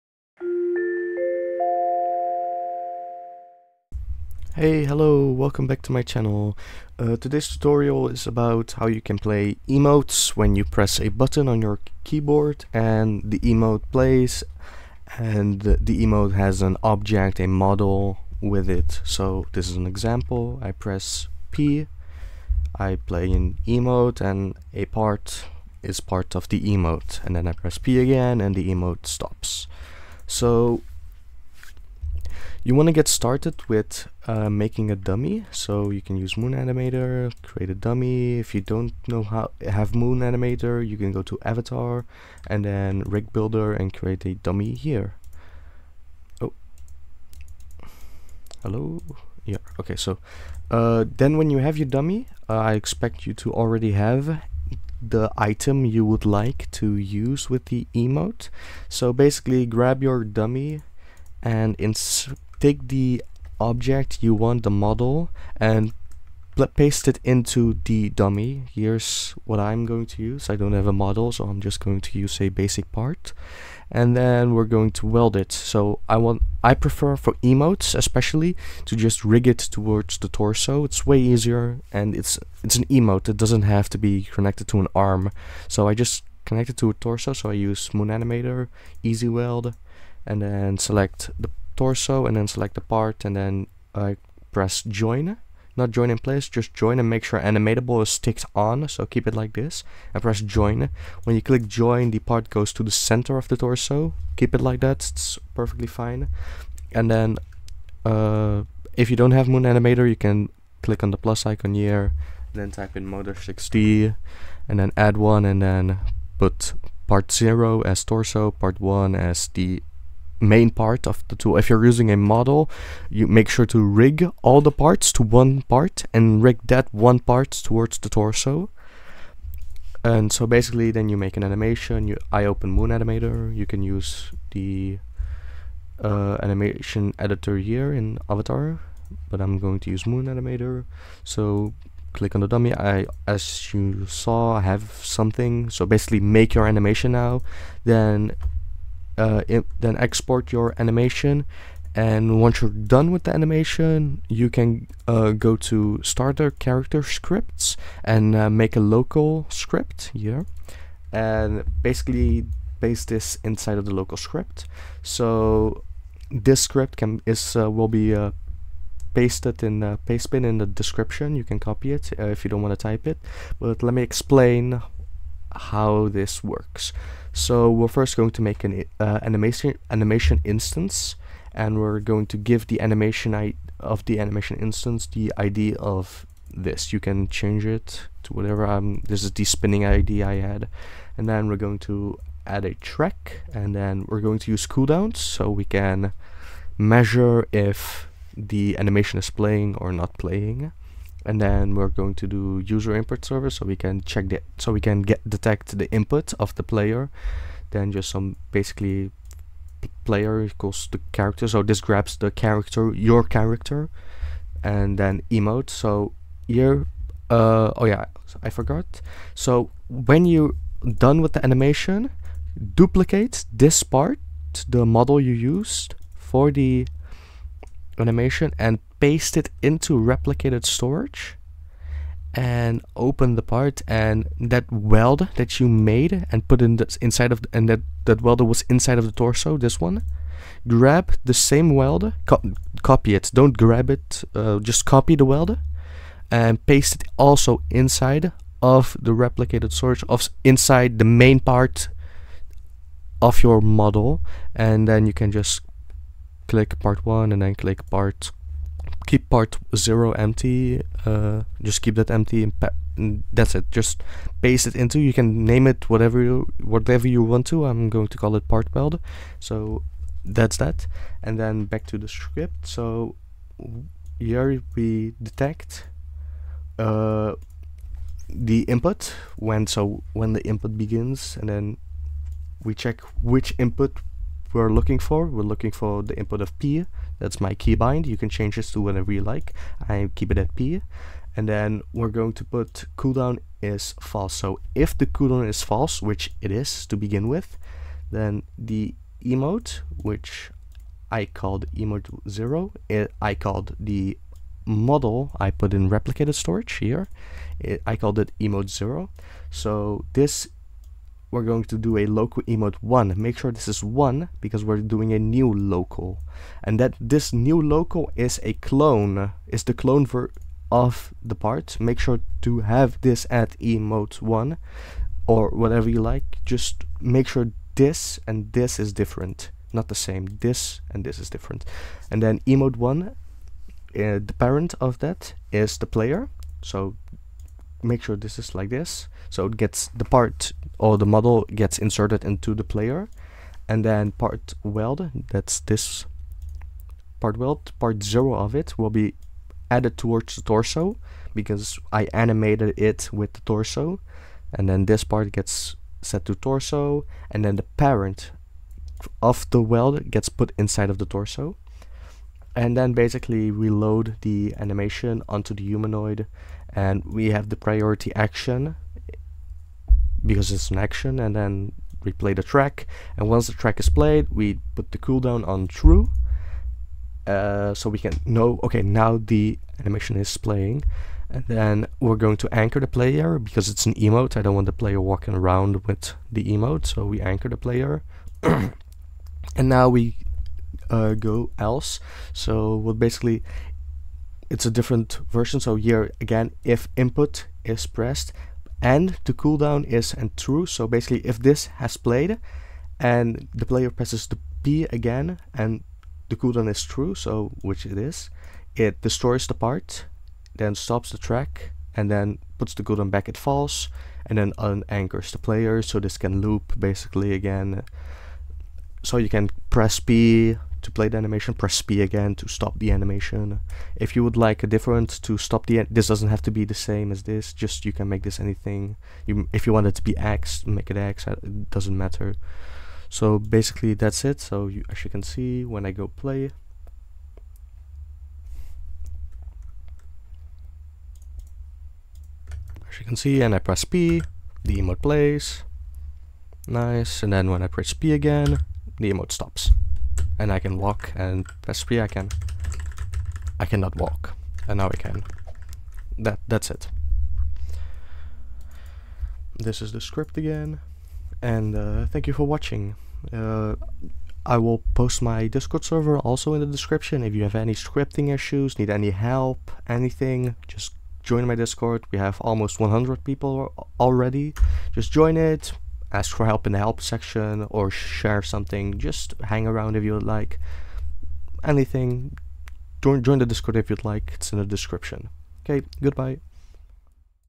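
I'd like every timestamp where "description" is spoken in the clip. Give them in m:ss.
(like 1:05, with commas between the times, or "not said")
2:50, 7:46, 8:04.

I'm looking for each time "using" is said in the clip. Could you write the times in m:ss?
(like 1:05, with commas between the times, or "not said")
2:01.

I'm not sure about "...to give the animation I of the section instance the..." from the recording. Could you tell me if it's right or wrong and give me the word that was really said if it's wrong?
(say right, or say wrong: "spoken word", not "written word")
wrong: "animation", not "section".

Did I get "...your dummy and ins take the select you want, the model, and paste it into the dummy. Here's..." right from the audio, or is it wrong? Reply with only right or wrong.
wrong.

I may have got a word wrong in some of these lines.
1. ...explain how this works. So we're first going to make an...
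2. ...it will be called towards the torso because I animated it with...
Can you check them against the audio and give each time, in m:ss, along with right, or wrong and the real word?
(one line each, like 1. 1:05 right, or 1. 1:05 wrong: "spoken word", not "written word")
1. 2:54 right
2. 5:48 wrong: "added", not "called".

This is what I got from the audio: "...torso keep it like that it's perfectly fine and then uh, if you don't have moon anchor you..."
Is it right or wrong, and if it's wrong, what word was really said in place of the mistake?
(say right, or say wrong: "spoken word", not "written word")
wrong: "animator", not "anchor".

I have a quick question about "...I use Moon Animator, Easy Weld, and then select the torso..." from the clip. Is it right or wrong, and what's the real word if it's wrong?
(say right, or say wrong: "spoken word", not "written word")
right.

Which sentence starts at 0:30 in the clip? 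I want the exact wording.
So you want to get started with uh, making a dummy, so you can use Moon Animator, create a dummy.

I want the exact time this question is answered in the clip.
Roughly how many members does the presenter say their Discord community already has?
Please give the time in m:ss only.
7:52.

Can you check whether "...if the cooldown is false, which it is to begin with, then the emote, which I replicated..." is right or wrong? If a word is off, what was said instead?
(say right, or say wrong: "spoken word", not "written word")
wrong: "called", not "replicated".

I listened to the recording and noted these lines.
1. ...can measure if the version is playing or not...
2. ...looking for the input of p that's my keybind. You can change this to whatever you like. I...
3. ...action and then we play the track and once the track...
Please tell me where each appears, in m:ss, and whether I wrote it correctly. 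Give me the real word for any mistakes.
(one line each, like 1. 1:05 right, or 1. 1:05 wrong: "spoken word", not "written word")
1. 3:15 wrong: "animation", not "version"
2. 4:45 right
3. 6:10 right.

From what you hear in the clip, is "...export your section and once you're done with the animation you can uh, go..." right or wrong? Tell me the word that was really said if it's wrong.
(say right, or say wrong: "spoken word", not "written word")
wrong: "animation", not "section".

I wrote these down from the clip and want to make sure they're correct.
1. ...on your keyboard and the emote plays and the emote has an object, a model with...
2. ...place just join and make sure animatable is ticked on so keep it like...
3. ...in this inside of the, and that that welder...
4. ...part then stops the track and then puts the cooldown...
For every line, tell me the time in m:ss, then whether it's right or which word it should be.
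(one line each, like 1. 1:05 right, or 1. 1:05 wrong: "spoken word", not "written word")
1. 0:11 right
2. 1:36 right
3. 3:56 right
4. 6:49 right.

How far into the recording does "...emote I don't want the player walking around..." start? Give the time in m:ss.
6:23.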